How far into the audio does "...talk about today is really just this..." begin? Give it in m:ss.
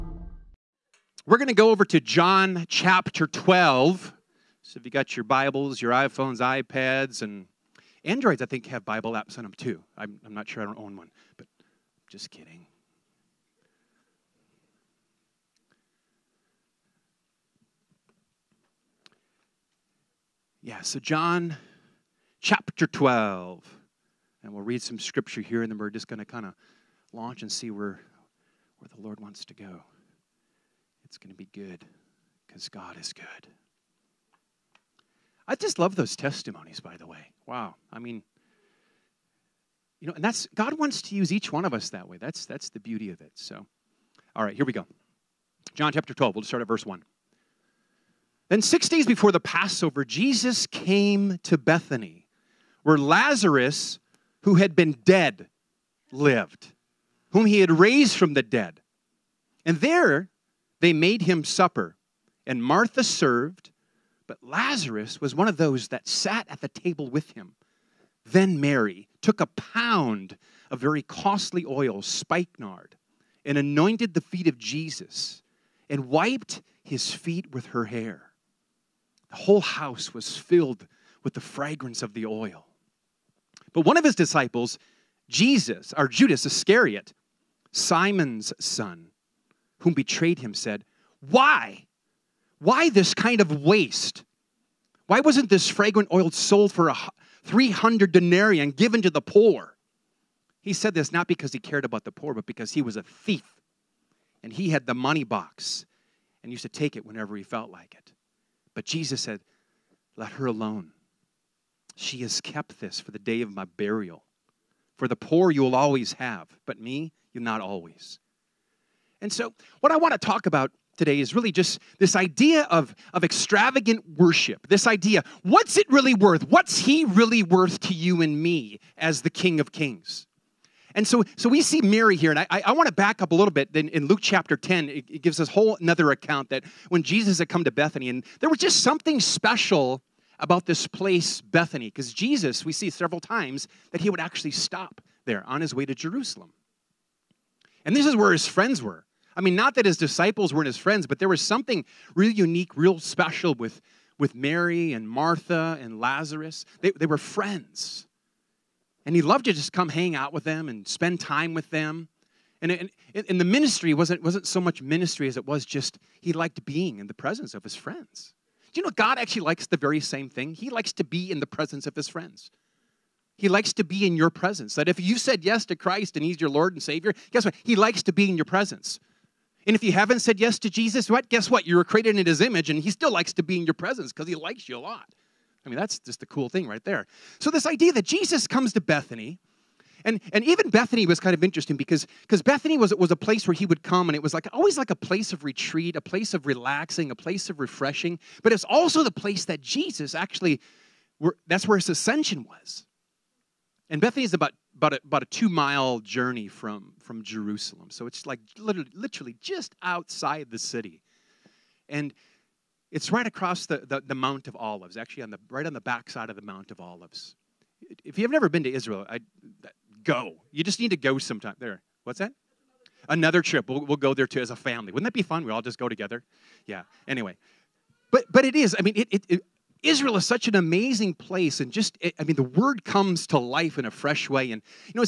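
2:00.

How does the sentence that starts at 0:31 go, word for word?
It's going to be good because God is good.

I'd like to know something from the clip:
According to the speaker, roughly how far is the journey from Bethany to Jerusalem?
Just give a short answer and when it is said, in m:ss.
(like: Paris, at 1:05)
2 miles, at 3:25.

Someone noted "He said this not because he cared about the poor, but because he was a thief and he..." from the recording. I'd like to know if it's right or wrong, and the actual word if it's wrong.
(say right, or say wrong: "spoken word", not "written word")
right.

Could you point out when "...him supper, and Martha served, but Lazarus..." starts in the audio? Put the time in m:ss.
1:01.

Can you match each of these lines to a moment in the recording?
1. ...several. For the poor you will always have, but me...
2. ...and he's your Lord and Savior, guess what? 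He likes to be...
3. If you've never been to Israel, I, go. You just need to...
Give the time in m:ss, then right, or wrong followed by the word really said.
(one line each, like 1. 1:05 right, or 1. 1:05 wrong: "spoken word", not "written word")
1. 1:53 wrong: "burial", not "several"
2. 2:56 right
3. 3:38 right.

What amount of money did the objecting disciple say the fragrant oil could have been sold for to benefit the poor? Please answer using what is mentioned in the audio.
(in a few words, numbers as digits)
300 denarii.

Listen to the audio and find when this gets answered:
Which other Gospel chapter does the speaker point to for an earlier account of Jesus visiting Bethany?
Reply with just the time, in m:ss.
2:14.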